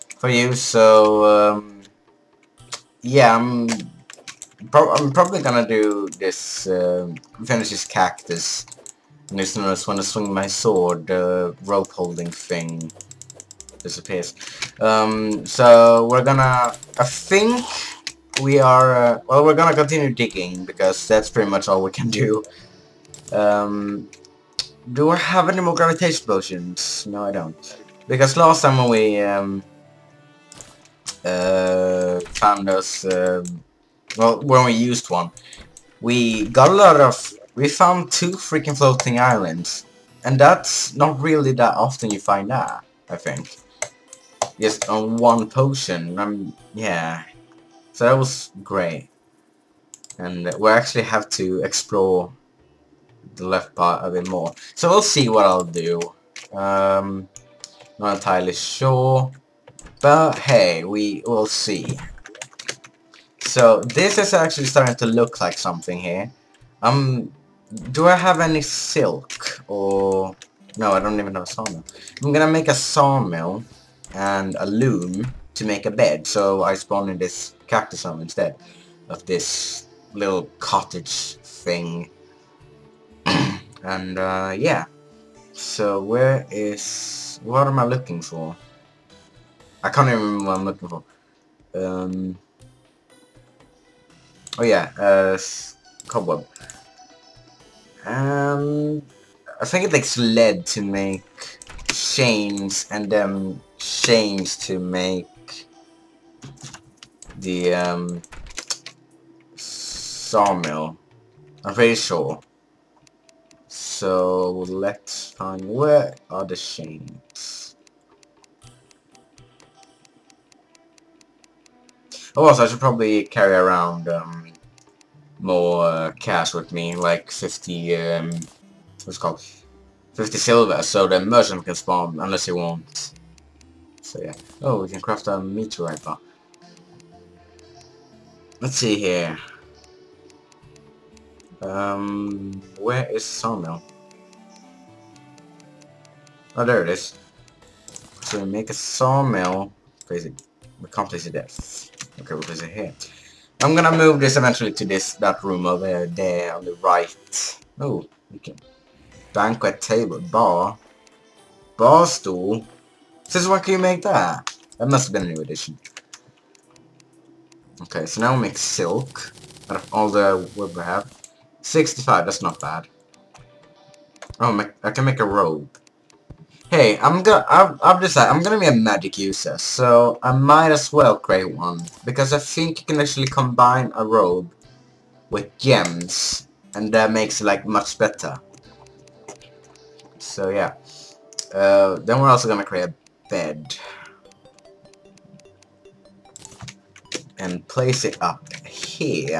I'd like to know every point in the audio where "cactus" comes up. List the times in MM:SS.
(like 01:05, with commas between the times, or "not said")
00:07, 01:17.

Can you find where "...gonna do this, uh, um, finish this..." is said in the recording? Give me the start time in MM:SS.
00:05.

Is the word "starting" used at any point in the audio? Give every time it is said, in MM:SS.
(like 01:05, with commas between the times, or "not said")
01:04.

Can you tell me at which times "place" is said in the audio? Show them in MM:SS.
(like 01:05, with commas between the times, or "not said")
02:31, 03:17.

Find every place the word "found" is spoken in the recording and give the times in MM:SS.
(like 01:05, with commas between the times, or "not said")
00:32, 00:37.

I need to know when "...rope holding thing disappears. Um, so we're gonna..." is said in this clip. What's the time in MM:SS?
00:11.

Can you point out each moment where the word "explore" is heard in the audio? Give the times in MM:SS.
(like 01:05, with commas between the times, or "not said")
00:51.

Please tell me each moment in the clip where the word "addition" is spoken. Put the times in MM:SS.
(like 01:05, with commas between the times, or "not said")
02:45.